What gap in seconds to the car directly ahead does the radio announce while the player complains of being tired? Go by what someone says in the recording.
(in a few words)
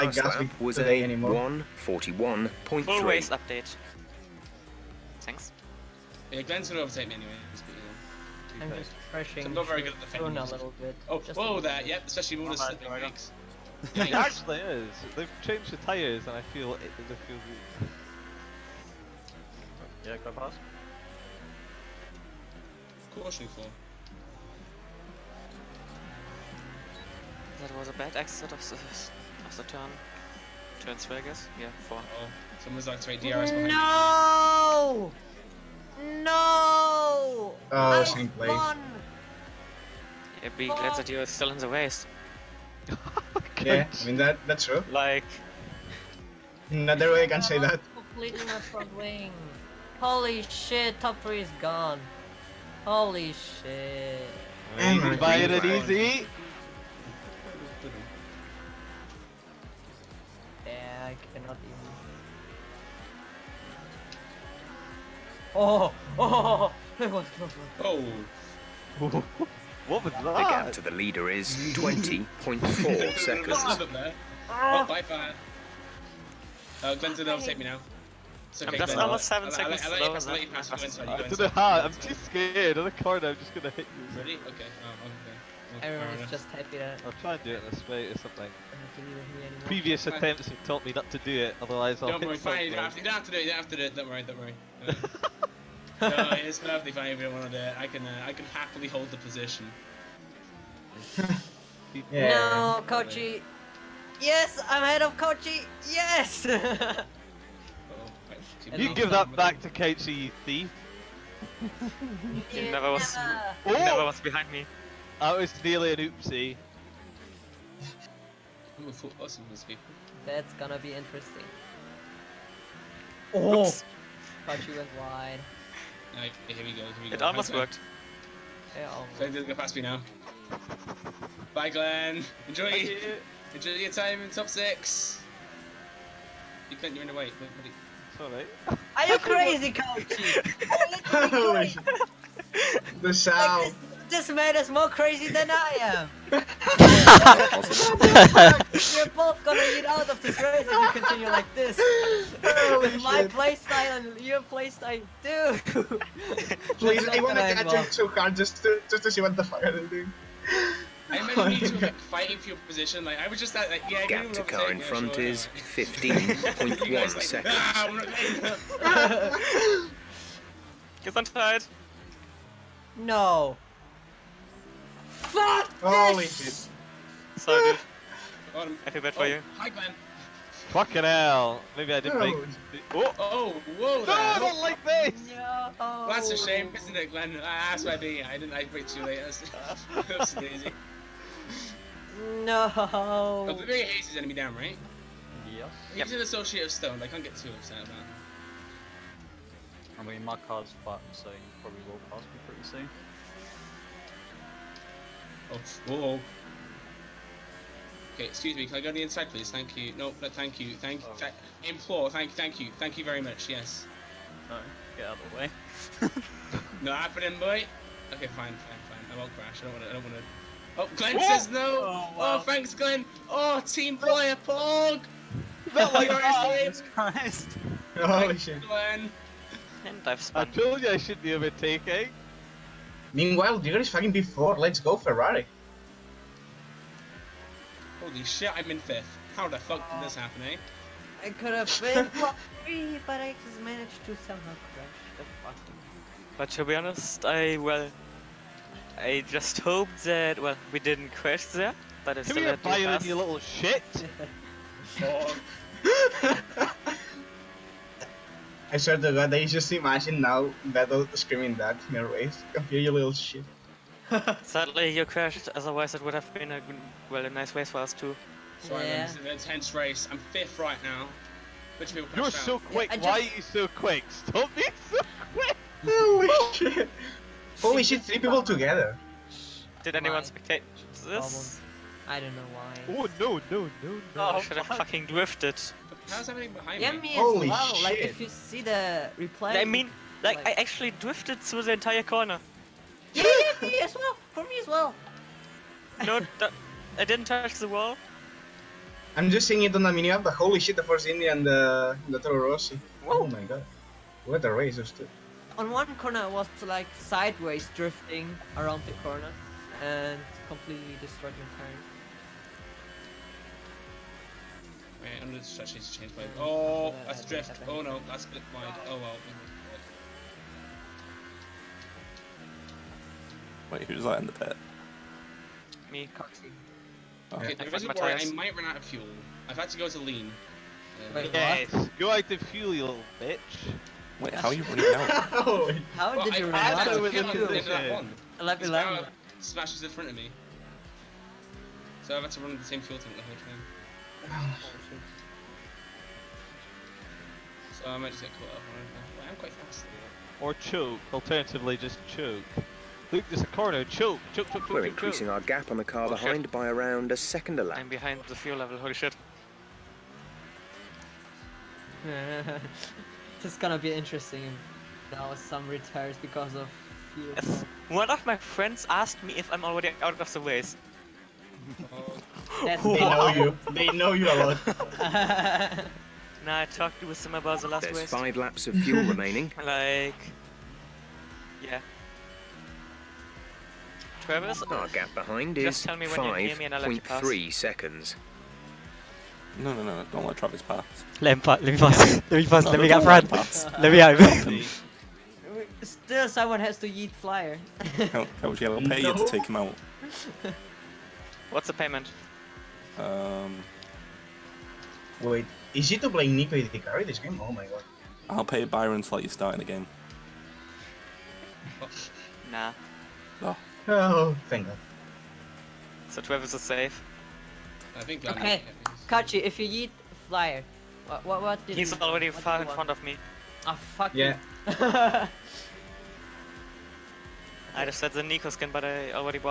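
15.1 seconds.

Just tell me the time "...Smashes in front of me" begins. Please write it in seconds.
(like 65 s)
339 s.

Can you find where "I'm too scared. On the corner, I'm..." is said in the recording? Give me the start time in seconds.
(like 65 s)
81 s.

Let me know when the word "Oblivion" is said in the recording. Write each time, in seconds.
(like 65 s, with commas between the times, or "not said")
193 s.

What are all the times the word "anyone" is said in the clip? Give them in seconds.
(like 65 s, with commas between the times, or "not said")
279 s.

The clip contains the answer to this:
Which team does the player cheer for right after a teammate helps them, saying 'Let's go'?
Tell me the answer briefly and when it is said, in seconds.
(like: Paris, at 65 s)
Ferrari, at 234 s.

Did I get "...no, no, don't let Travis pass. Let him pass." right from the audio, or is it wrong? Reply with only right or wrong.
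right.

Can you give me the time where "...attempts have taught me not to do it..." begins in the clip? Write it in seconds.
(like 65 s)
90 s.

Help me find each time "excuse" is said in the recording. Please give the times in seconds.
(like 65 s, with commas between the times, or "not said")
208 s.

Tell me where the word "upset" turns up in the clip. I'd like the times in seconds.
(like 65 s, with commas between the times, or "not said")
197 s.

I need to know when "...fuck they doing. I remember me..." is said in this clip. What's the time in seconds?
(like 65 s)
159 s.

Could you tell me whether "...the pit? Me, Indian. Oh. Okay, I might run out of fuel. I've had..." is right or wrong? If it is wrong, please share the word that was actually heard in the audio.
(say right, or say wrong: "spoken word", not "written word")
wrong: "Coxie", not "Indian".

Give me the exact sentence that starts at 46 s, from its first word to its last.
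Another way I can say that.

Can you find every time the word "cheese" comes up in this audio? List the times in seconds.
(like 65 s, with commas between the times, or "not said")
not said.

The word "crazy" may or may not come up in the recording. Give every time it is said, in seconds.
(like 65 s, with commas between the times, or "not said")
139 s, 144 s.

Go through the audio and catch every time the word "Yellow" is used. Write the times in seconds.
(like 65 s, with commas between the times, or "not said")
398 s.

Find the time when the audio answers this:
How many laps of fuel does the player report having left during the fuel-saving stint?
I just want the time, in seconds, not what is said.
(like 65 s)
378 s.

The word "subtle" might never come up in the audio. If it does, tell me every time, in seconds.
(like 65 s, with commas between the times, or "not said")
not said.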